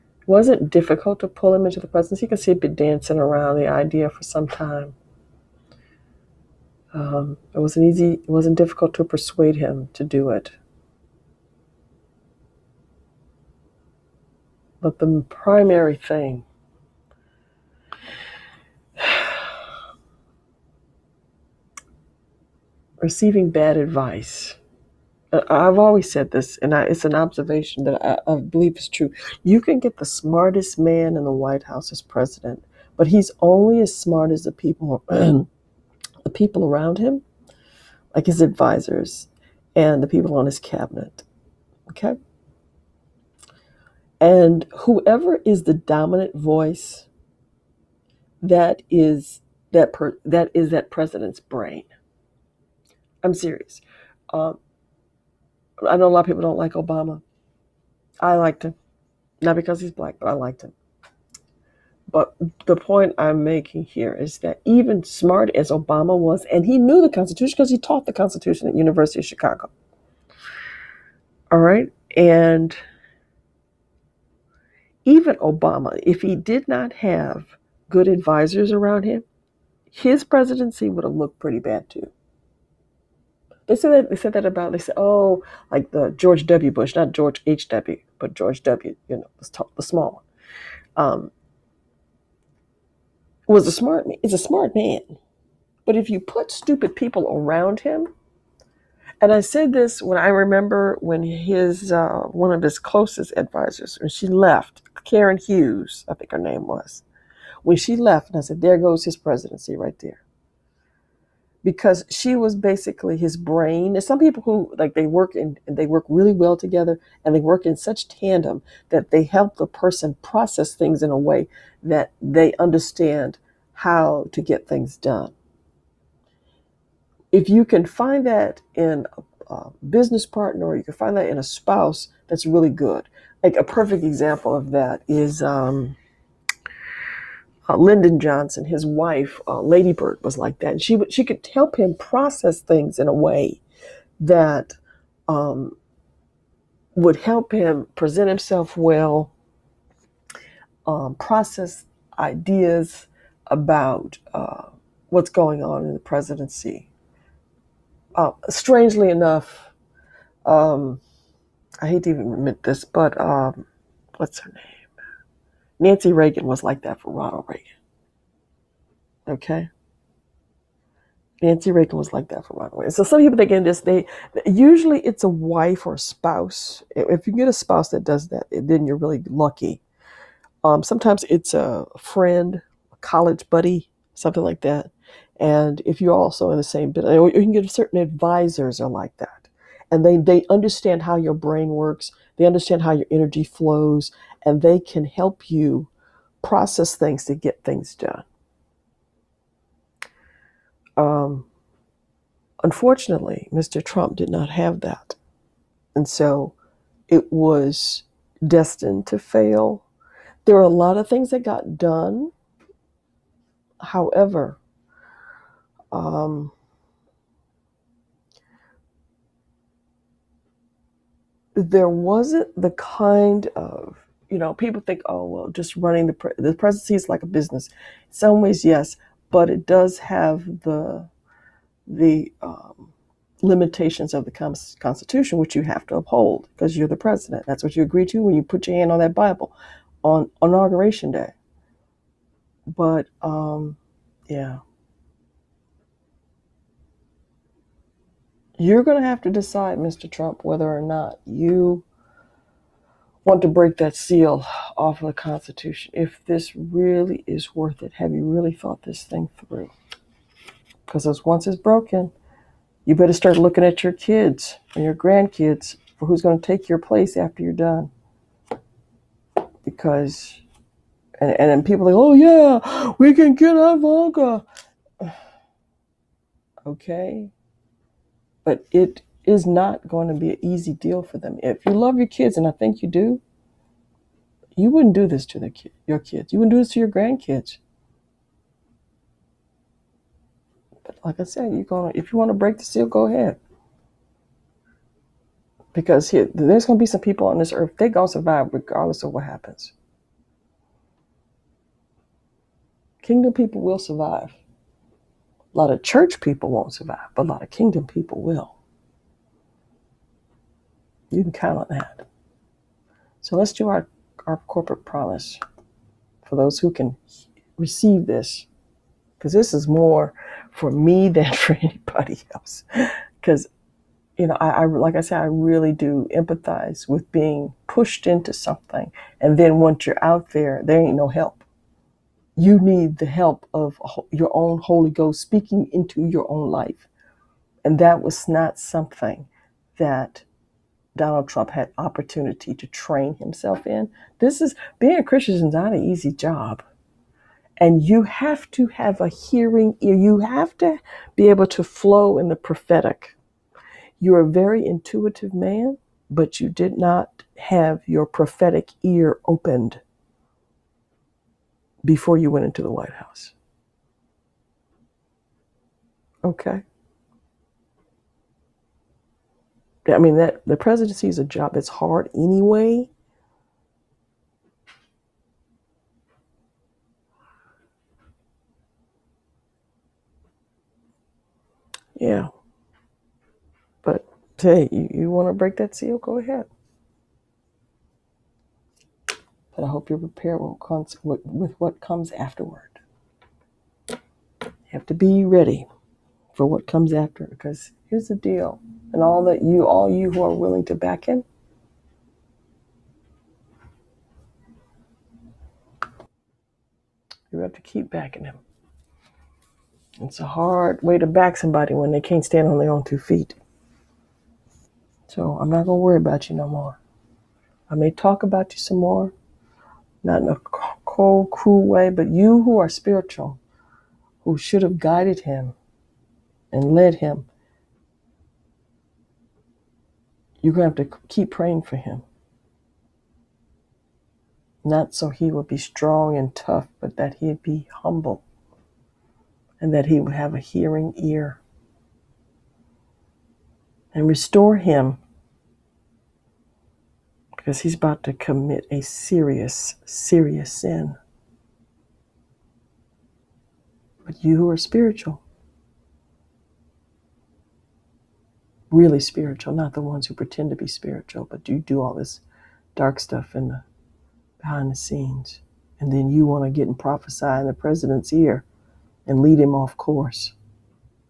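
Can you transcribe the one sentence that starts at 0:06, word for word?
Um, it wasn't easy, it wasn't difficult to persuade him to do it.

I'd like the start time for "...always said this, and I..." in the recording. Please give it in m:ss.
0:25.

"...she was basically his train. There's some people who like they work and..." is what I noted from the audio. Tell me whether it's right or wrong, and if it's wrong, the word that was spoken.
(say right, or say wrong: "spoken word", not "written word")
wrong: "brain", not "train".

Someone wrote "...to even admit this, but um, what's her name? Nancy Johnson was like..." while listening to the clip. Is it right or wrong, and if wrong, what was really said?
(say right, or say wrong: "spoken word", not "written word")
wrong: "Reagan", not "Johnson".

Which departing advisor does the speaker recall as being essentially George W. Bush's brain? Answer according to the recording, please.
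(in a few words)
Karen Hughes.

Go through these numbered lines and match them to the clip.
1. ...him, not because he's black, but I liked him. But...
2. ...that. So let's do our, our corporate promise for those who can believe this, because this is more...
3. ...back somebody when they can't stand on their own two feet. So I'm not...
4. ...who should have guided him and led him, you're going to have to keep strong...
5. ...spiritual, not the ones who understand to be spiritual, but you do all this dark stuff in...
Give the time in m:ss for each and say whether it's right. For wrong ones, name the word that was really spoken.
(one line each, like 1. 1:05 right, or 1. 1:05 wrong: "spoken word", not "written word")
1. 0:58 right
2. 5:11 wrong: "receive", not "believe"
3. 6:51 right
4. 7:04 wrong: "praying", not "strong"
5. 7:39 wrong: "pretend", not "understand".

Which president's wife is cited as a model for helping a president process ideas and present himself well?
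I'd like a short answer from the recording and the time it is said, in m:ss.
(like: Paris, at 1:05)
Lyndon Johnson, at 2:17.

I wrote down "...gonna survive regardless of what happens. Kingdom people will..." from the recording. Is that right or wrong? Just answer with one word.
right.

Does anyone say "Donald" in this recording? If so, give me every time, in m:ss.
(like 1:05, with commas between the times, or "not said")
5:40.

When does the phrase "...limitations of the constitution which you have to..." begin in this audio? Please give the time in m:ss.
3:53.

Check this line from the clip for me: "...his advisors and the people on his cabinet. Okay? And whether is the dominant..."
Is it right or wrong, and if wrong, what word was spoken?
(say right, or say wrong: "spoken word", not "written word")
wrong: "whoever", not "whether".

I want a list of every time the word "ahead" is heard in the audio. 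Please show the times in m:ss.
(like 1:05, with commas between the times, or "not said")
4:53, 6:26.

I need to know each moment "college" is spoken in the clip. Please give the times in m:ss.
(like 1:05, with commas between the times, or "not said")
3:02.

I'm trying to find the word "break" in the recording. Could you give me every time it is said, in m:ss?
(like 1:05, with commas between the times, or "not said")
4:13, 4:52, 6:25.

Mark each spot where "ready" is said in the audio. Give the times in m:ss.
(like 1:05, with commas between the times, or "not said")
6:35.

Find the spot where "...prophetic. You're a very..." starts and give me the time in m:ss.
5:52.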